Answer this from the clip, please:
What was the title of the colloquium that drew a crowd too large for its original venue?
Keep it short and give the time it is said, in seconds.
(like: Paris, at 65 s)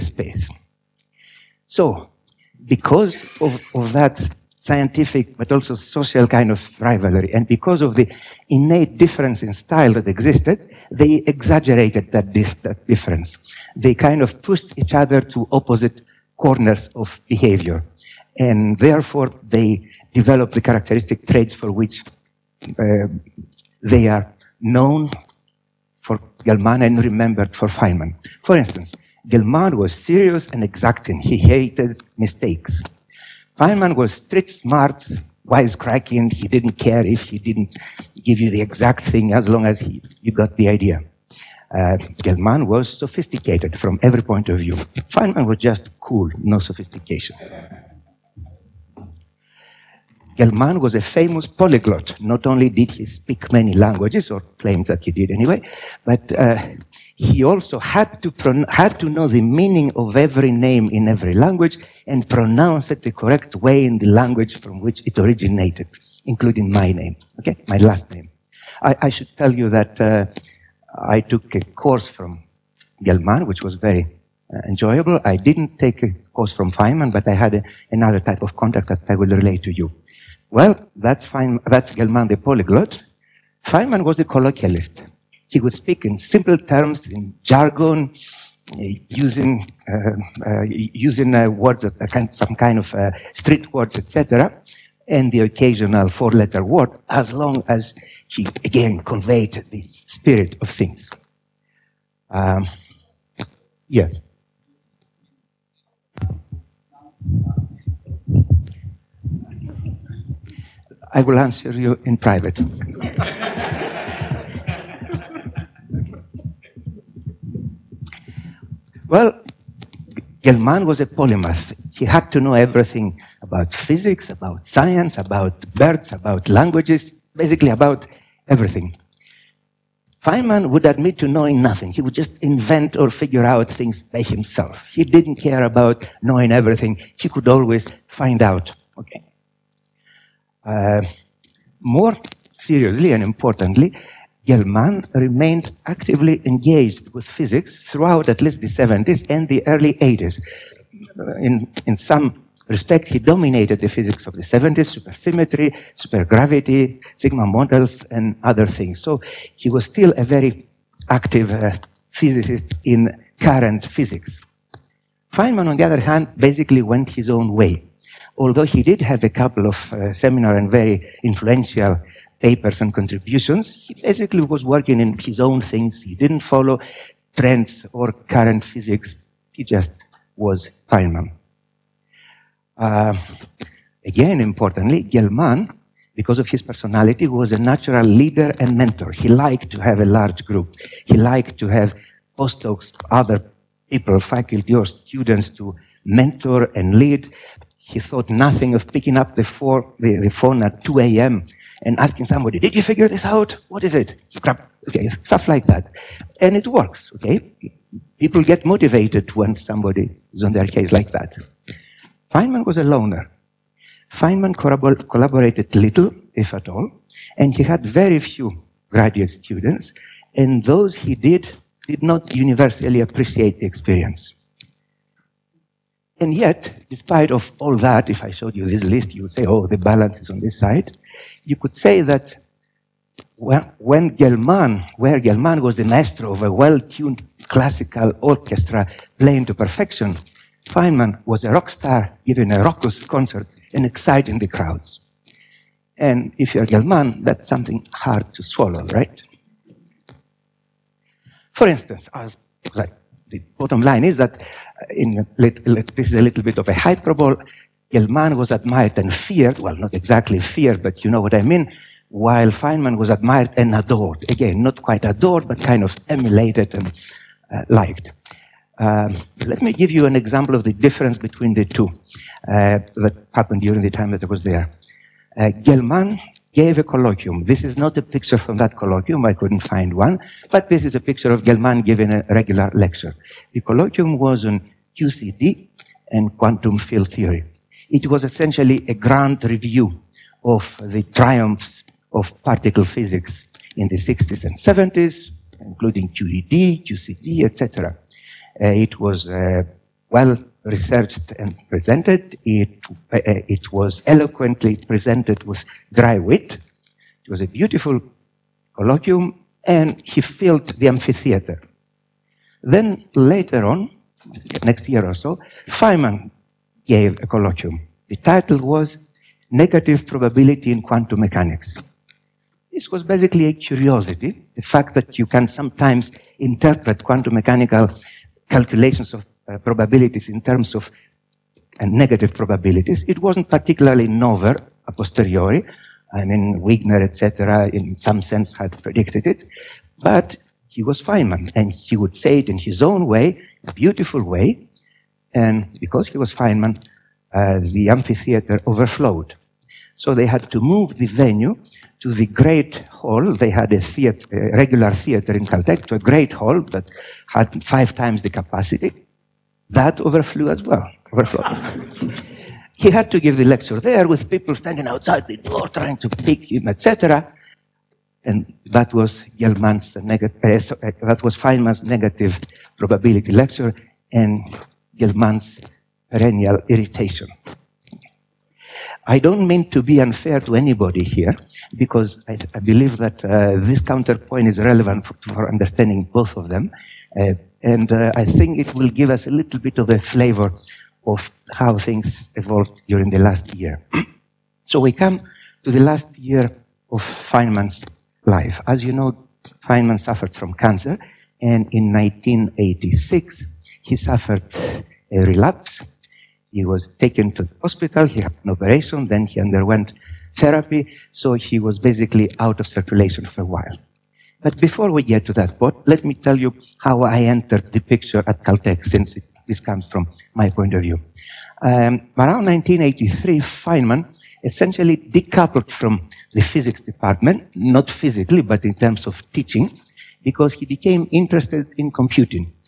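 Negative Probability in Quantum Mechanics, at 319 s.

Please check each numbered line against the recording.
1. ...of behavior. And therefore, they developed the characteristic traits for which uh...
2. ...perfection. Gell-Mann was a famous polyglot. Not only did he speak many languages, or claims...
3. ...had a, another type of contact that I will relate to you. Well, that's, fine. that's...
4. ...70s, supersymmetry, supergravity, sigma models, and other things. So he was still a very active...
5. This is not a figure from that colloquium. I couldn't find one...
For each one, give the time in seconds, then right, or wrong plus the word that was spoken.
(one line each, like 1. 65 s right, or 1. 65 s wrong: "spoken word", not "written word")
1. 16 s right
2. 46 s wrong: "sophistication", not "perfection"
3. 77 s right
4. 154 s right
5. 277 s wrong: "picture", not "figure".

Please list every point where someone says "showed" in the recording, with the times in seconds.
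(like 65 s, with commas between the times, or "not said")
228 s.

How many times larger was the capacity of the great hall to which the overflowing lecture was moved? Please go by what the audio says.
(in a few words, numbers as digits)
5.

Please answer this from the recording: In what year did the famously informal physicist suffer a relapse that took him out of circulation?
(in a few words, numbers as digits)
1986.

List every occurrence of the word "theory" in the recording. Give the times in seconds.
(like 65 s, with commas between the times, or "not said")
287 s.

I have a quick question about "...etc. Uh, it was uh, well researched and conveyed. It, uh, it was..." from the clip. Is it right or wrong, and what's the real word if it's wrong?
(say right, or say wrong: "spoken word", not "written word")
wrong: "presented", not "conveyed".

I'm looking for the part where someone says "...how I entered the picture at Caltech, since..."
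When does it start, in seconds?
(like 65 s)
416 s.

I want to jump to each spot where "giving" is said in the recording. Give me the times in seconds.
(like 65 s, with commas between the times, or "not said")
242 s, 281 s.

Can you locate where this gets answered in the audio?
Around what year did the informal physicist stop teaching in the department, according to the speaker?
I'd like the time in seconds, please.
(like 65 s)
422 s.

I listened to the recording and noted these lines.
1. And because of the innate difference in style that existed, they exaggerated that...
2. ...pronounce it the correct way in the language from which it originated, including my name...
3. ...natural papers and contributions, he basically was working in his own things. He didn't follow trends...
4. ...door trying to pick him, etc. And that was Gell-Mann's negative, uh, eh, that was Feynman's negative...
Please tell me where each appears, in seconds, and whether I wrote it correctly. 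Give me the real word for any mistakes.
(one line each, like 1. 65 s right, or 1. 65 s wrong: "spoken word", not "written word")
1. 7 s right
2. 62 s right
3. 171 s wrong: "influential", not "natural"
4. 365 s right.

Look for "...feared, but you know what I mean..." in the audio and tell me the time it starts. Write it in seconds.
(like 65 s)
260 s.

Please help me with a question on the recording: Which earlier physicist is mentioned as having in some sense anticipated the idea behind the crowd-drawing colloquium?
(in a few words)
Wigner.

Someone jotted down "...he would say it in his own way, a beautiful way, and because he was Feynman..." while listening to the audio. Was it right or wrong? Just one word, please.
right.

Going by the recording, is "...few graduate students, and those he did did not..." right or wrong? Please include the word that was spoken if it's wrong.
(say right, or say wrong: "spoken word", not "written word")
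right.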